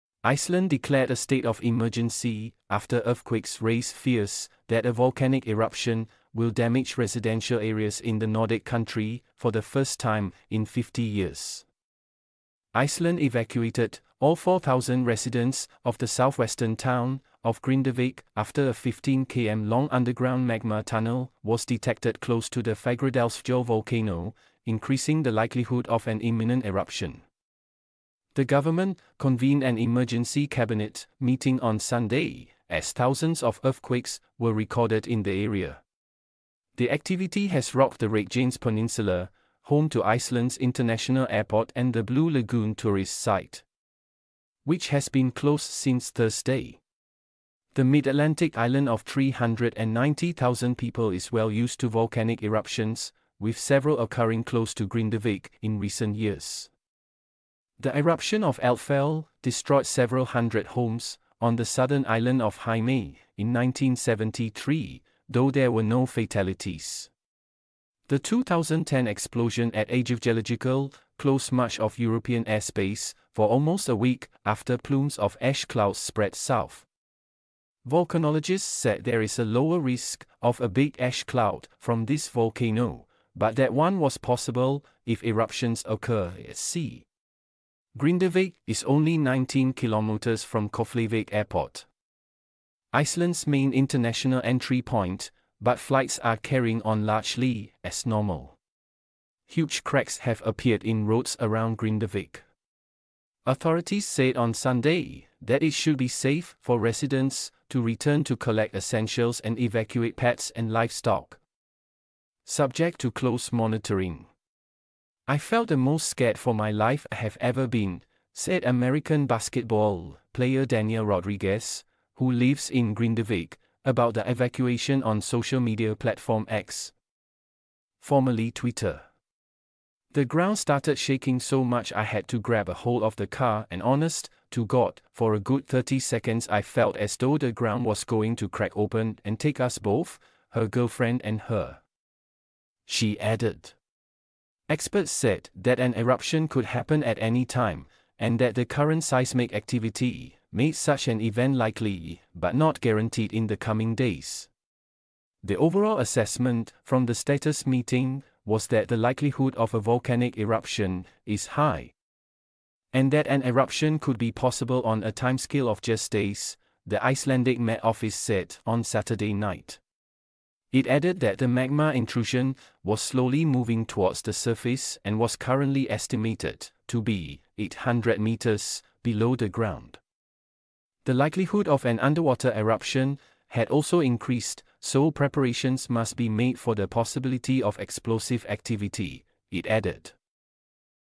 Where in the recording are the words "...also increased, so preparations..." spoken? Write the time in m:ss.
3:03.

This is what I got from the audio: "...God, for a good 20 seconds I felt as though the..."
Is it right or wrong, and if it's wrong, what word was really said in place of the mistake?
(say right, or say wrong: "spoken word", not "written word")
wrong: "30", not "20".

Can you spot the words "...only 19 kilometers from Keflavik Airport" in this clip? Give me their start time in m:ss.
1:28.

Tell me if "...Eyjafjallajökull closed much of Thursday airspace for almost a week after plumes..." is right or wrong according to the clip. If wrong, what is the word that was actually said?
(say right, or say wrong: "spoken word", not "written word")
wrong: "European", not "Thursday".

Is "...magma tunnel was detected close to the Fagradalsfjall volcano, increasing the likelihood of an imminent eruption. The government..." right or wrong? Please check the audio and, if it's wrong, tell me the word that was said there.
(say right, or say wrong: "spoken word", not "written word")
right.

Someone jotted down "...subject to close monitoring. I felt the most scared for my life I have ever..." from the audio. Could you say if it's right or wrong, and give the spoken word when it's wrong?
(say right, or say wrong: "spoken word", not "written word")
right.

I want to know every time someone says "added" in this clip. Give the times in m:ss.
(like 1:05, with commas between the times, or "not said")
2:23, 2:50, 3:09.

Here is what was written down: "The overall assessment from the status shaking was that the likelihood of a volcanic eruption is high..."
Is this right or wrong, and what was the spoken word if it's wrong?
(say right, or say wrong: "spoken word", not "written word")
wrong: "meeting", not "shaking".